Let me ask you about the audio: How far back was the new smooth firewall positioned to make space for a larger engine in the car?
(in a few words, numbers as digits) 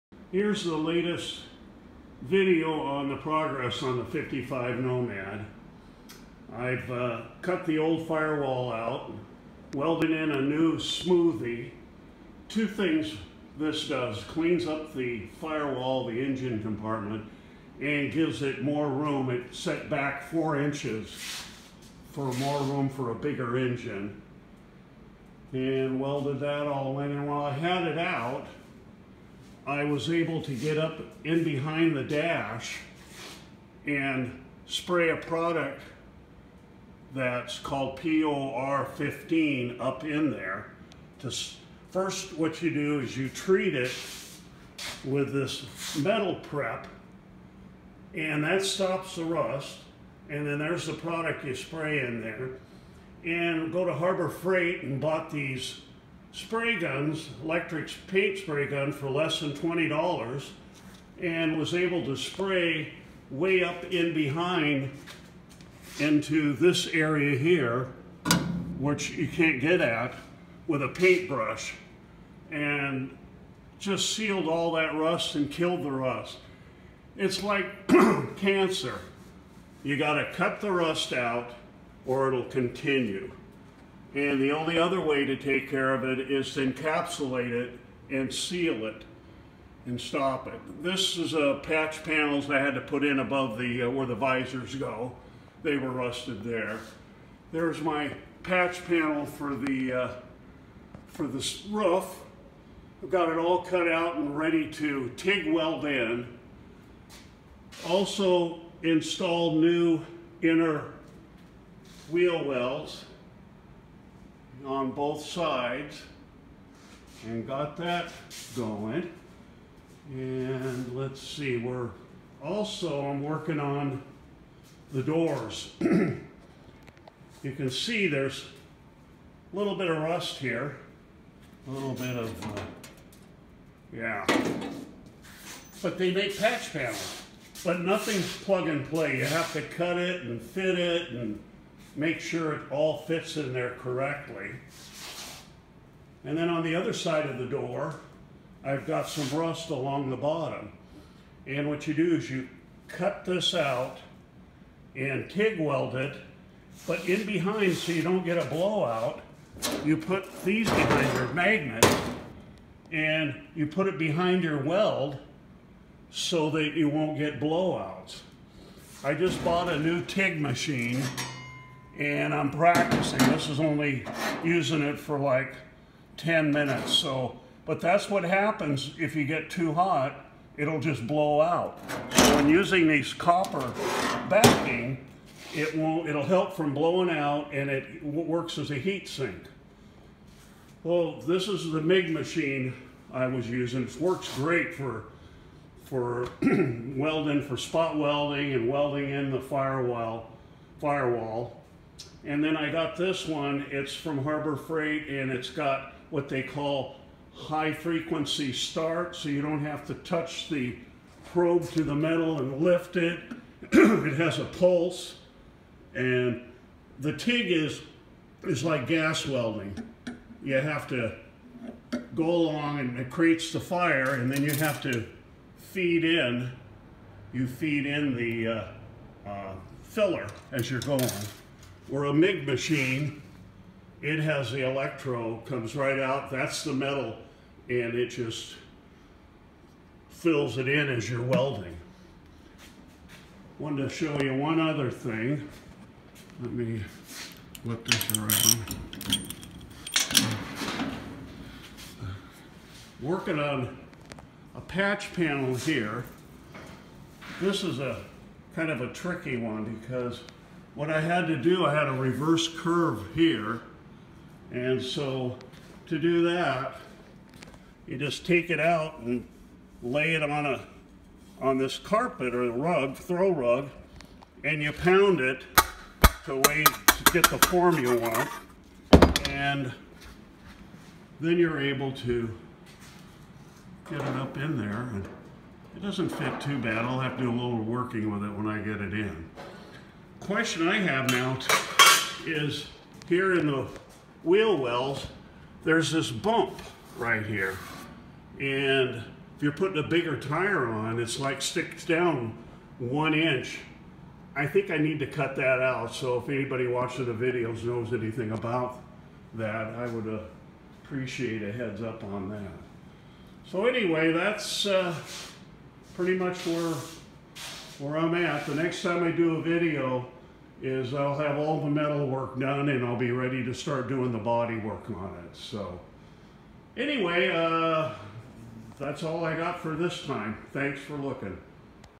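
4 inches.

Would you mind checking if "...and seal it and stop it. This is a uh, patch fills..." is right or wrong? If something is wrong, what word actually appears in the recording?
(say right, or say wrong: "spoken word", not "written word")
wrong: "panels", not "fills".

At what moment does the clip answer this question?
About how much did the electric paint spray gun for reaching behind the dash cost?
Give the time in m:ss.
0:59.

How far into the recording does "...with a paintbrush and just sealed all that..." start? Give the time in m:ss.
1:10.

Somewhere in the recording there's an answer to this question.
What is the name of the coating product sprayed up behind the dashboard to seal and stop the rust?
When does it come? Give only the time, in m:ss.
0:37.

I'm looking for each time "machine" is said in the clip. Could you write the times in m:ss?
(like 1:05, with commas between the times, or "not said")
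2:50, 3:12, 3:52.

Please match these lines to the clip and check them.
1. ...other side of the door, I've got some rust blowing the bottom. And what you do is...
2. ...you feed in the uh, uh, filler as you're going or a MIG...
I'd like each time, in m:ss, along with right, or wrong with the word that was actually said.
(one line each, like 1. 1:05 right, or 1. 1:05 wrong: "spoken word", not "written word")
1. 2:26 wrong: "along", not "blowing"
2. 3:47 right.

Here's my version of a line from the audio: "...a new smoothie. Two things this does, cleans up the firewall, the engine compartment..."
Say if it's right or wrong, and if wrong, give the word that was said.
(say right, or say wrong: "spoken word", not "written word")
right.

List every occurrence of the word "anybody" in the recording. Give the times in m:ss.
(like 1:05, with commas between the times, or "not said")
5:06.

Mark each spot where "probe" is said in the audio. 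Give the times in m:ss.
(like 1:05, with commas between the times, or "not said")
3:31.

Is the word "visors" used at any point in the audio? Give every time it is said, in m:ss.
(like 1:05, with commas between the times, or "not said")
1:34.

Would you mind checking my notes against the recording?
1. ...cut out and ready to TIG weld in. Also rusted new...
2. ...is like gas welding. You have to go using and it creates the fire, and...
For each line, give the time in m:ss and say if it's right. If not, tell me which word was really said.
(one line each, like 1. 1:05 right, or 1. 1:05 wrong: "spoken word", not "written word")
1. 1:43 wrong: "installed", not "rusted"
2. 3:38 wrong: "along", not "using".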